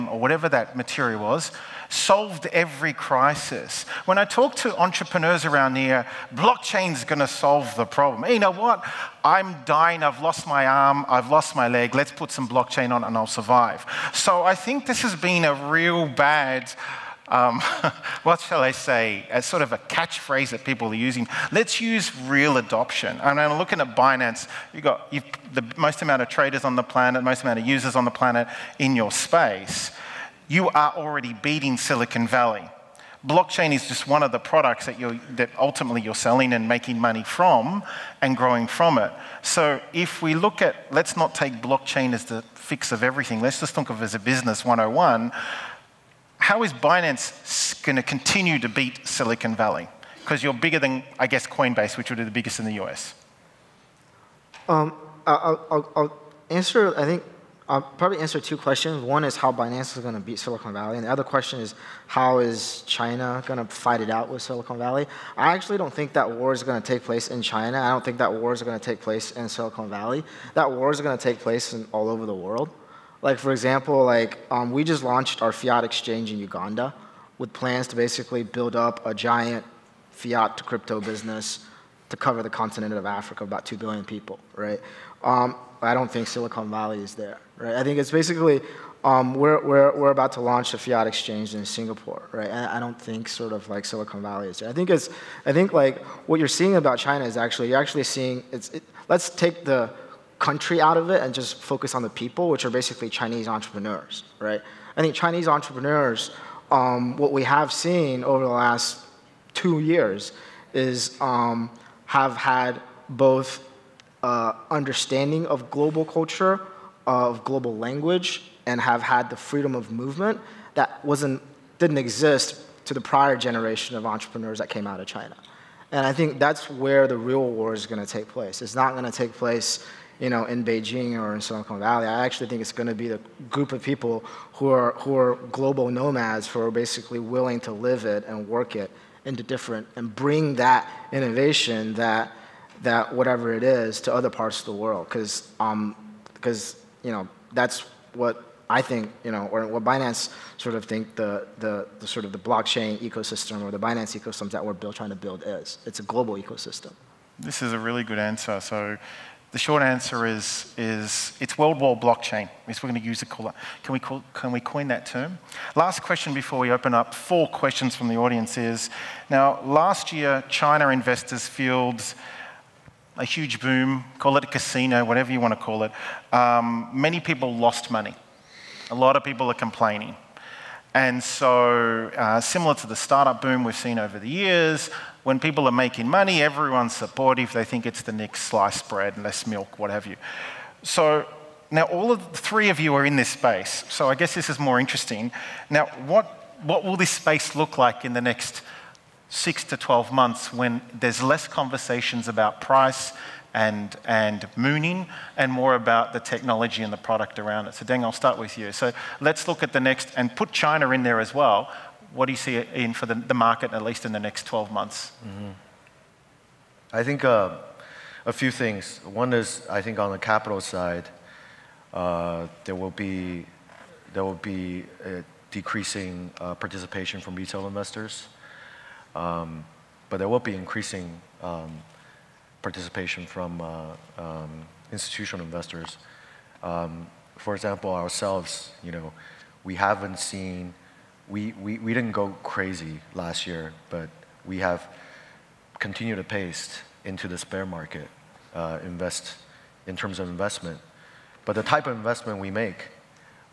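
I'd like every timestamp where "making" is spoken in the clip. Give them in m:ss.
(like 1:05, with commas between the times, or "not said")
0:36, 3:05.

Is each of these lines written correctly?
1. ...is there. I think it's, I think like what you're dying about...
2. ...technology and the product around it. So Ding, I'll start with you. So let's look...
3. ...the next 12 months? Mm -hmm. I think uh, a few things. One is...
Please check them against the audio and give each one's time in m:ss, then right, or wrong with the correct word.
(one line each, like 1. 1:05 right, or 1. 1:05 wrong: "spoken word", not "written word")
1. 1:34 wrong: "seeing", not "dying"
2. 3:26 right
3. 3:34 right.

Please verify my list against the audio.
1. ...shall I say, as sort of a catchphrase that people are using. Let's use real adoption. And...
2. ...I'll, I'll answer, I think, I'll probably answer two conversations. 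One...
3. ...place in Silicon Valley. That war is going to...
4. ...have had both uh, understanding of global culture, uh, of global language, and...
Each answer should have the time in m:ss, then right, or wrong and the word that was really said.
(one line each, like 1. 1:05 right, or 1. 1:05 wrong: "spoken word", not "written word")
1. 0:18 right
2. 0:55 wrong: "questions", not "conversations"
3. 1:09 right
4. 1:52 right.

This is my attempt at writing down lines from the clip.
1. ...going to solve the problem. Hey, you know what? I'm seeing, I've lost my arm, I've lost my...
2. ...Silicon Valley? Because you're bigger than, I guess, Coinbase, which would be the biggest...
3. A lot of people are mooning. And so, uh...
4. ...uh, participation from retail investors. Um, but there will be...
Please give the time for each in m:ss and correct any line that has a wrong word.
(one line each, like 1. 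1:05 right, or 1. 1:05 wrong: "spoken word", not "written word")
1. 0:07 wrong: "dying", not "seeing"
2. 0:49 right
3. 2:58 wrong: "complaining", not "mooning"
4. 3:46 right.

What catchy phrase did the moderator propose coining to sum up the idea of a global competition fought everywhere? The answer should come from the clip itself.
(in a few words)
world war blockchain.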